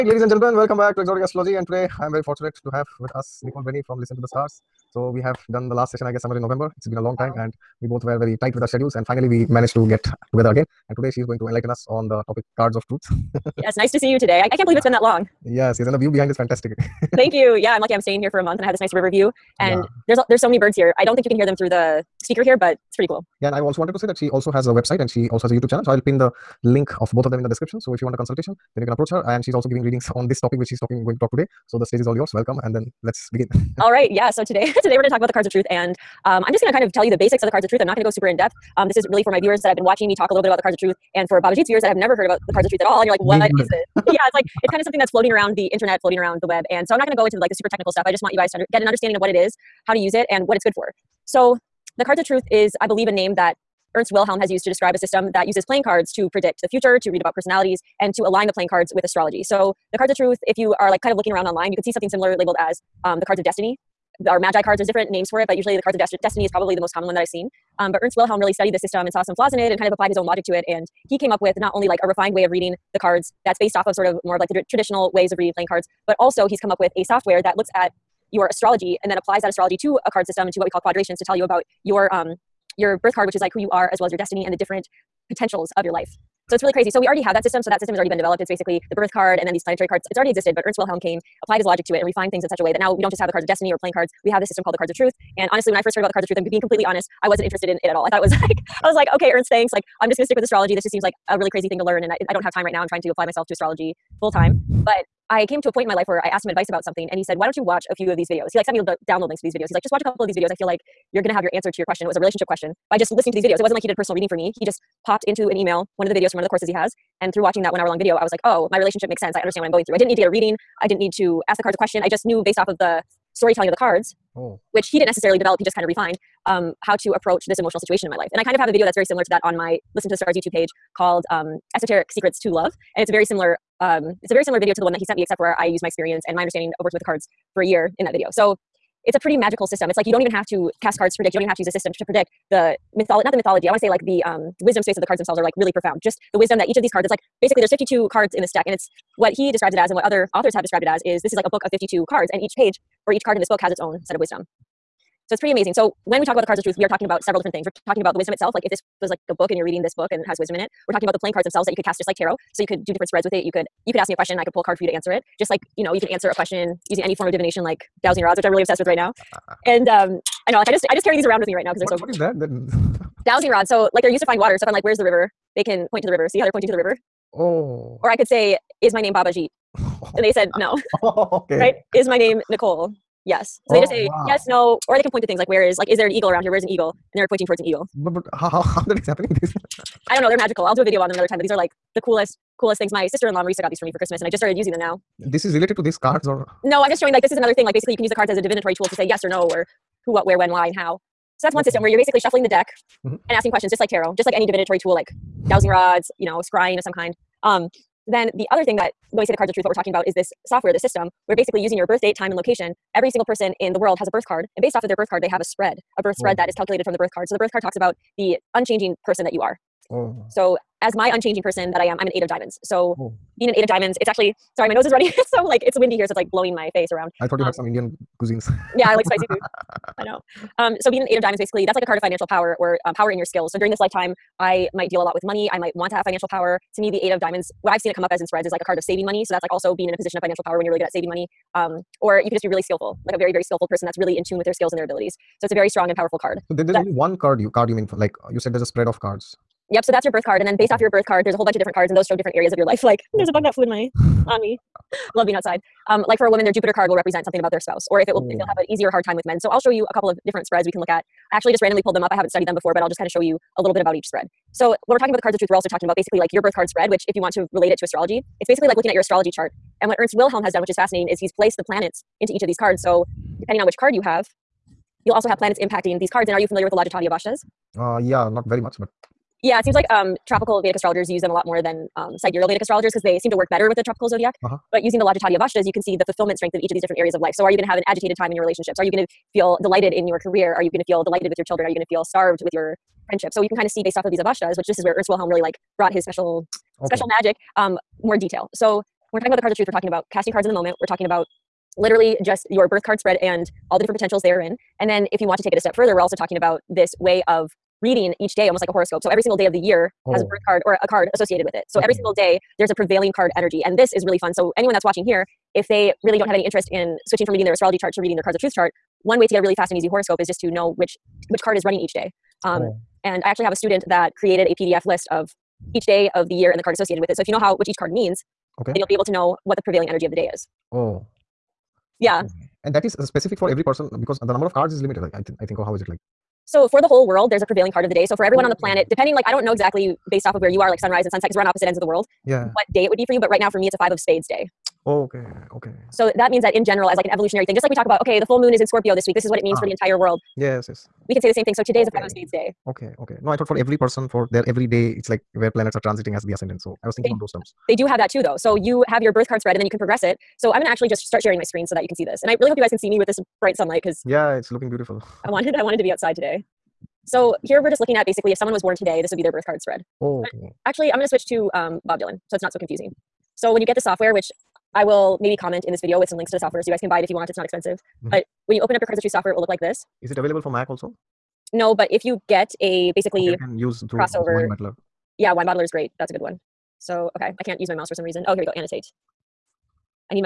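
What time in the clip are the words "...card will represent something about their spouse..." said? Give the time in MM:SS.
04:16.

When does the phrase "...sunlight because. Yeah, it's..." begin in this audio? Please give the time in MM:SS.
06:03.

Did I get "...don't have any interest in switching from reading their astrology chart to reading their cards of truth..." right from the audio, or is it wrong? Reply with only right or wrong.
right.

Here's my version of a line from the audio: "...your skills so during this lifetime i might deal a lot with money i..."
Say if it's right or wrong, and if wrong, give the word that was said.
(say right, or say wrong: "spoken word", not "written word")
right.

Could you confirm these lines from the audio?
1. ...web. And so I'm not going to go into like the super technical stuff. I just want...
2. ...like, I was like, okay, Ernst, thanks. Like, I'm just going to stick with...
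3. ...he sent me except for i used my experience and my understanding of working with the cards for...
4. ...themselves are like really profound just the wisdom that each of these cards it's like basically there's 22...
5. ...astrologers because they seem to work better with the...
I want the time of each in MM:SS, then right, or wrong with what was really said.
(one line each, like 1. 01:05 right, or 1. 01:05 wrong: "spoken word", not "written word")
1. 00:46 right
2. 01:38 right
3. 02:14 right
4. 02:25 wrong: "52", not "22"
5. 04:42 right.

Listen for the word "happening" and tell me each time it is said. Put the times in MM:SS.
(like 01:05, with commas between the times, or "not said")
03:09.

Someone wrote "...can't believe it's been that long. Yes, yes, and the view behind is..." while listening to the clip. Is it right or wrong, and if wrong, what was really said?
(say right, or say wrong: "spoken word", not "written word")
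right.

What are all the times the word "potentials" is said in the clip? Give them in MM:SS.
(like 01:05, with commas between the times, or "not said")
01:25, 05:03.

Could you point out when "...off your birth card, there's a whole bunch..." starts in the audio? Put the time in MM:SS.
04:10.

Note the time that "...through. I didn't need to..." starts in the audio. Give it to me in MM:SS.
01:59.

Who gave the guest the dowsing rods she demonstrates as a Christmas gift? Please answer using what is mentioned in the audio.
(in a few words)
Marisa.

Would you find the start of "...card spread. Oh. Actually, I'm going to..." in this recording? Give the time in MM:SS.
06:09.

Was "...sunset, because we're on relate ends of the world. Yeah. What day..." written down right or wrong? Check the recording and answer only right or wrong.
wrong.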